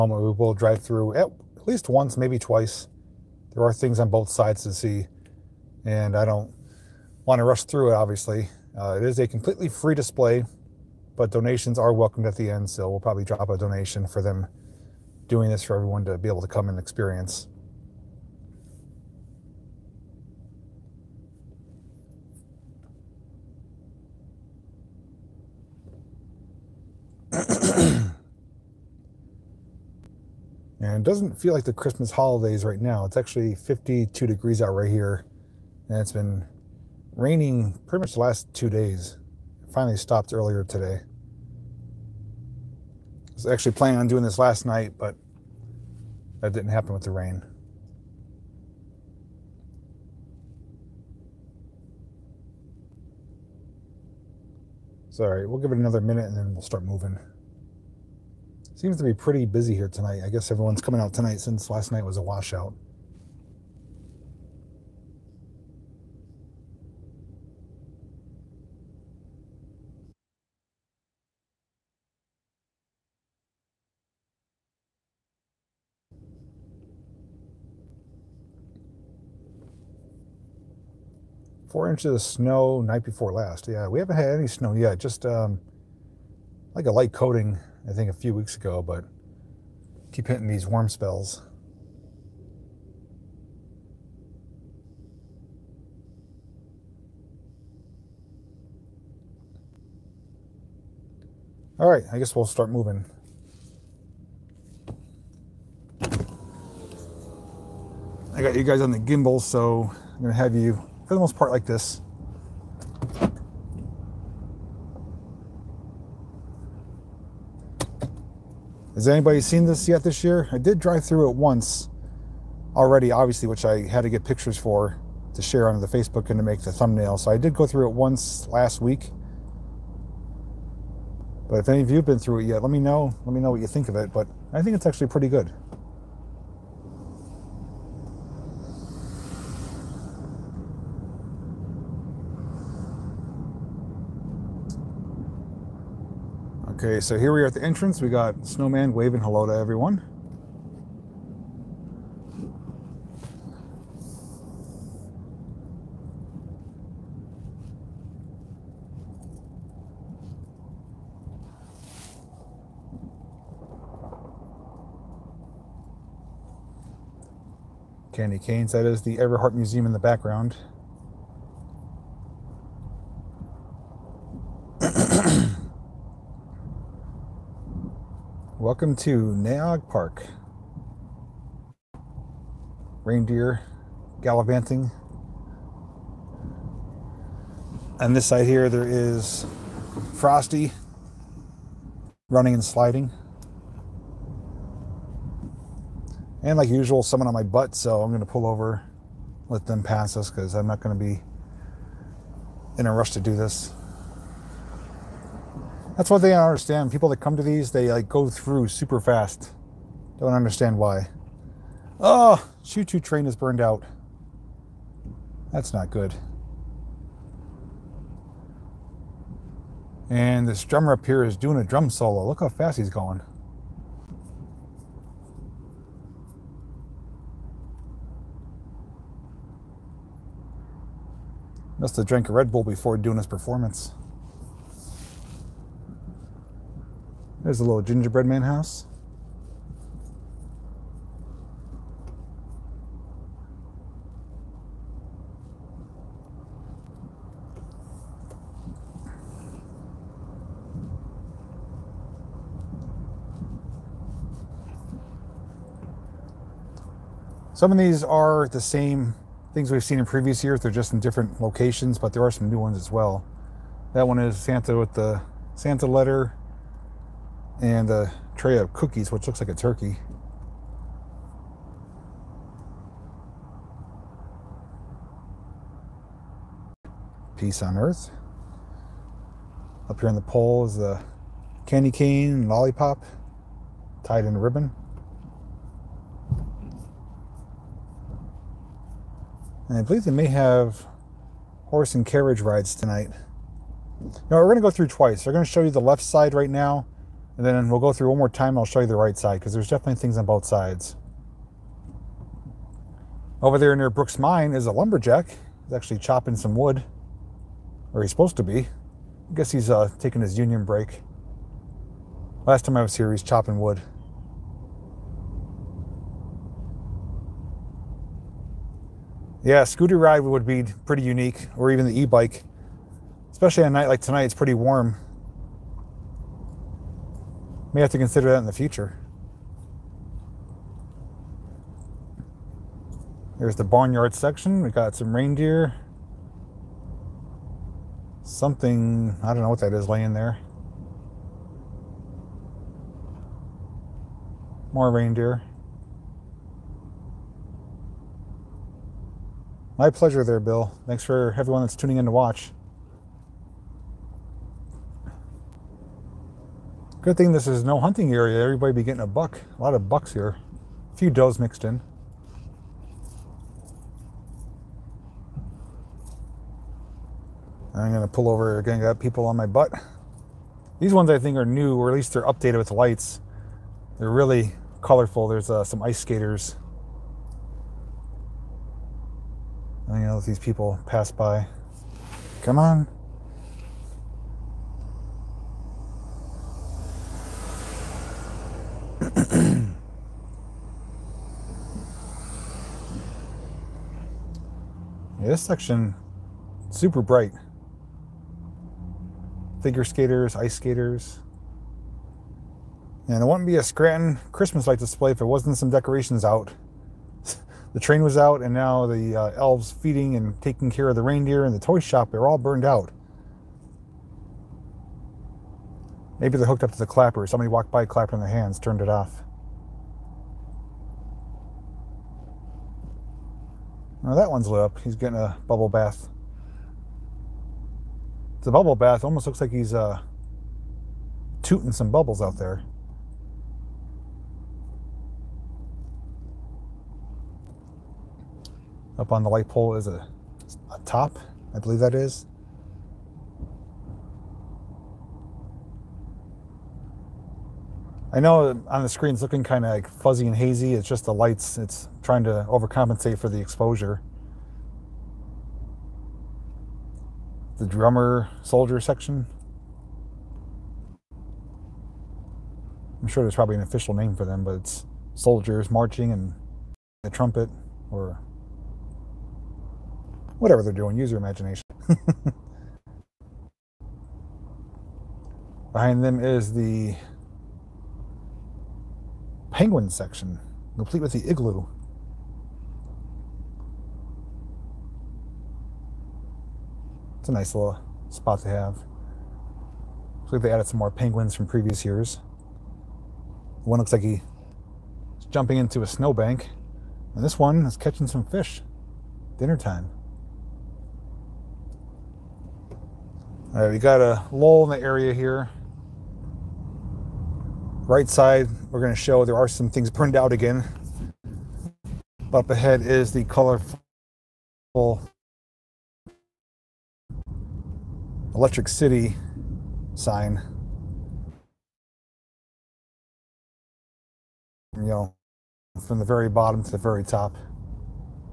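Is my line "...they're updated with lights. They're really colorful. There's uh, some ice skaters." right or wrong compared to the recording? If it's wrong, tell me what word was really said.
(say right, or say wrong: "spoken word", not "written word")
right.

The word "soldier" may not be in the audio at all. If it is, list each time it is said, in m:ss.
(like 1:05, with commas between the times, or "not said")
7:38, 7:45.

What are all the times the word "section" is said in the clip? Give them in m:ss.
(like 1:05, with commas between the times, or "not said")
5:34, 6:35, 7:38, 7:59.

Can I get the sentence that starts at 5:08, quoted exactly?
I guess he's uh, taking his union break.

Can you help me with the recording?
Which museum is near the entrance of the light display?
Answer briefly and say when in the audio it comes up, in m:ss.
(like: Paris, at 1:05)
Everhart Museum, at 2:49.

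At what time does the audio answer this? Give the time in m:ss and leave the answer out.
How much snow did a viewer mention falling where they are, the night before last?
1:21.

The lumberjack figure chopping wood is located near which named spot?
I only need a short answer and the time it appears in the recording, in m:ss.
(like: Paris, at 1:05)
Brooks Mine, at 5:03.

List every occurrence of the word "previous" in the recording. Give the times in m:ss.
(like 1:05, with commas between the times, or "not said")
4:20, 8:11.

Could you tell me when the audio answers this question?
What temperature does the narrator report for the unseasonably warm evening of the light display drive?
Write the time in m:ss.
0:33.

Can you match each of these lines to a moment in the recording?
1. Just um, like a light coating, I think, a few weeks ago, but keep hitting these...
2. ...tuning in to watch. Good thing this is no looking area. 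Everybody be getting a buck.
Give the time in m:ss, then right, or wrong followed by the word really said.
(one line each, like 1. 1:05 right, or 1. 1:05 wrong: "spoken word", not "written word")
1. 1:24 right
2. 5:51 wrong: "hunting", not "looking".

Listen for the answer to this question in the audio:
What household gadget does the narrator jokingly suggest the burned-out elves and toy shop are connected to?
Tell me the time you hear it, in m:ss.
6:56.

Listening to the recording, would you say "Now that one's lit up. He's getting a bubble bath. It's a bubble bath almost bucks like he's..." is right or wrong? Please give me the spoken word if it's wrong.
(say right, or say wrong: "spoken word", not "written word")
wrong: "looks", not "bucks".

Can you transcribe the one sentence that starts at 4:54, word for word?
Now we're going to go through twice.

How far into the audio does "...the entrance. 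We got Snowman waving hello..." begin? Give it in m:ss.
2:27.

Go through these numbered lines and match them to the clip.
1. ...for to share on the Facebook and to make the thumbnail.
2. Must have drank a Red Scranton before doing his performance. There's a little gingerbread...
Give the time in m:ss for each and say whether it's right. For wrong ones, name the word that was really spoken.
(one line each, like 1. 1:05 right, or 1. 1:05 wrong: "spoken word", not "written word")
1. 2:04 right
2. 3:51 wrong: "Bull", not "Scranton".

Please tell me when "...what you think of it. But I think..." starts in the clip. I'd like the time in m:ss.
2:13.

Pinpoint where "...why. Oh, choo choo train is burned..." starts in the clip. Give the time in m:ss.
3:30.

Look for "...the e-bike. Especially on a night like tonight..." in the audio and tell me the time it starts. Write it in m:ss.
5:21.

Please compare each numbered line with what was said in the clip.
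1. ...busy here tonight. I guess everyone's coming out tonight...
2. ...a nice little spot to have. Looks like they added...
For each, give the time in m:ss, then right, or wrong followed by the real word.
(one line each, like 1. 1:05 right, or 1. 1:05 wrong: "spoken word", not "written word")
1. 0:59 right
2. 8:07 right.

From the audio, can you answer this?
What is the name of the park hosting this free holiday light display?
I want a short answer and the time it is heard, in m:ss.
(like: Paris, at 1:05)
Nay Aug Park, at 2:59.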